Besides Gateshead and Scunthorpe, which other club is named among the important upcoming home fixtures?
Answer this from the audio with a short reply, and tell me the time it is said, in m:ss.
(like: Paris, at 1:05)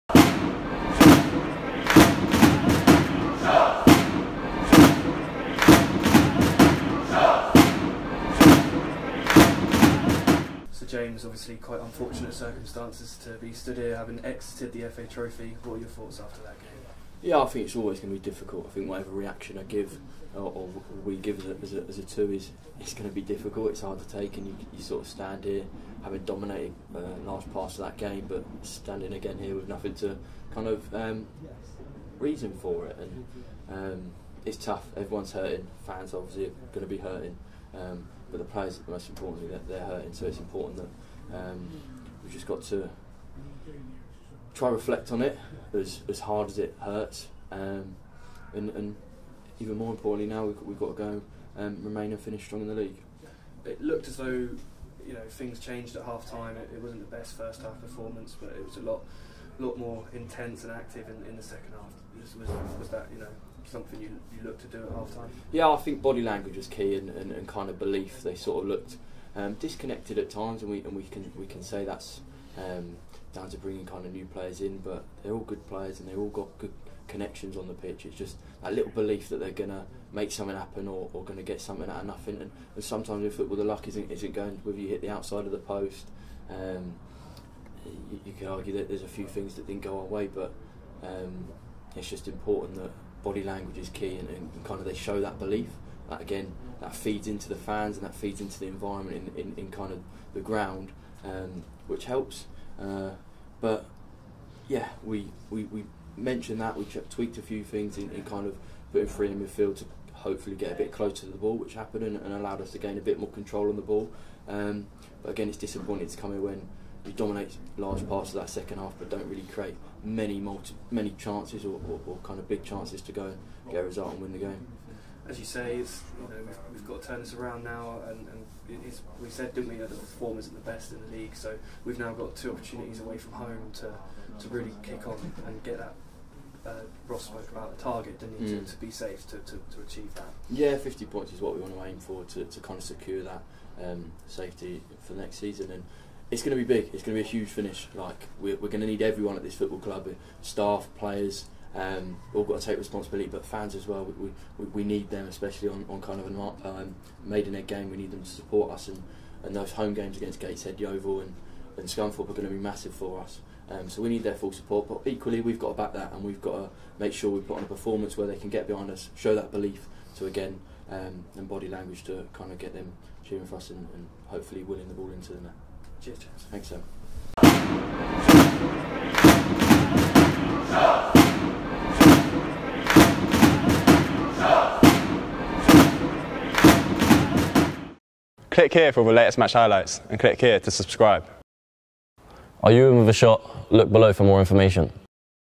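Yeovil, at 2:40.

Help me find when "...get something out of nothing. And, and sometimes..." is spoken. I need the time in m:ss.
1:21.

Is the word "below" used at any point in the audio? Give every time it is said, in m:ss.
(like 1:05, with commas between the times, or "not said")
3:13.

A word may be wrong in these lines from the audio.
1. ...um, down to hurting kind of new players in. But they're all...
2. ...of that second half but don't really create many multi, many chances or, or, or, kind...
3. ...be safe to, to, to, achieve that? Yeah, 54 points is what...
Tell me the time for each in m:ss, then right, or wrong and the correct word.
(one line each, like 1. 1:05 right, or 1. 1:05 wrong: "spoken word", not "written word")
1. 1:12 wrong: "bringing", not "hurting"
2. 1:58 right
3. 2:18 wrong: "50", not "54".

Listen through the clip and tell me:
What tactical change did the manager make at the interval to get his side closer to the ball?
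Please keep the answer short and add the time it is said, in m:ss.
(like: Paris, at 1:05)
three in midfield, at 1:49.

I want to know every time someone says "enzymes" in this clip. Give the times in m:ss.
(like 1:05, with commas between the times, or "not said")
not said.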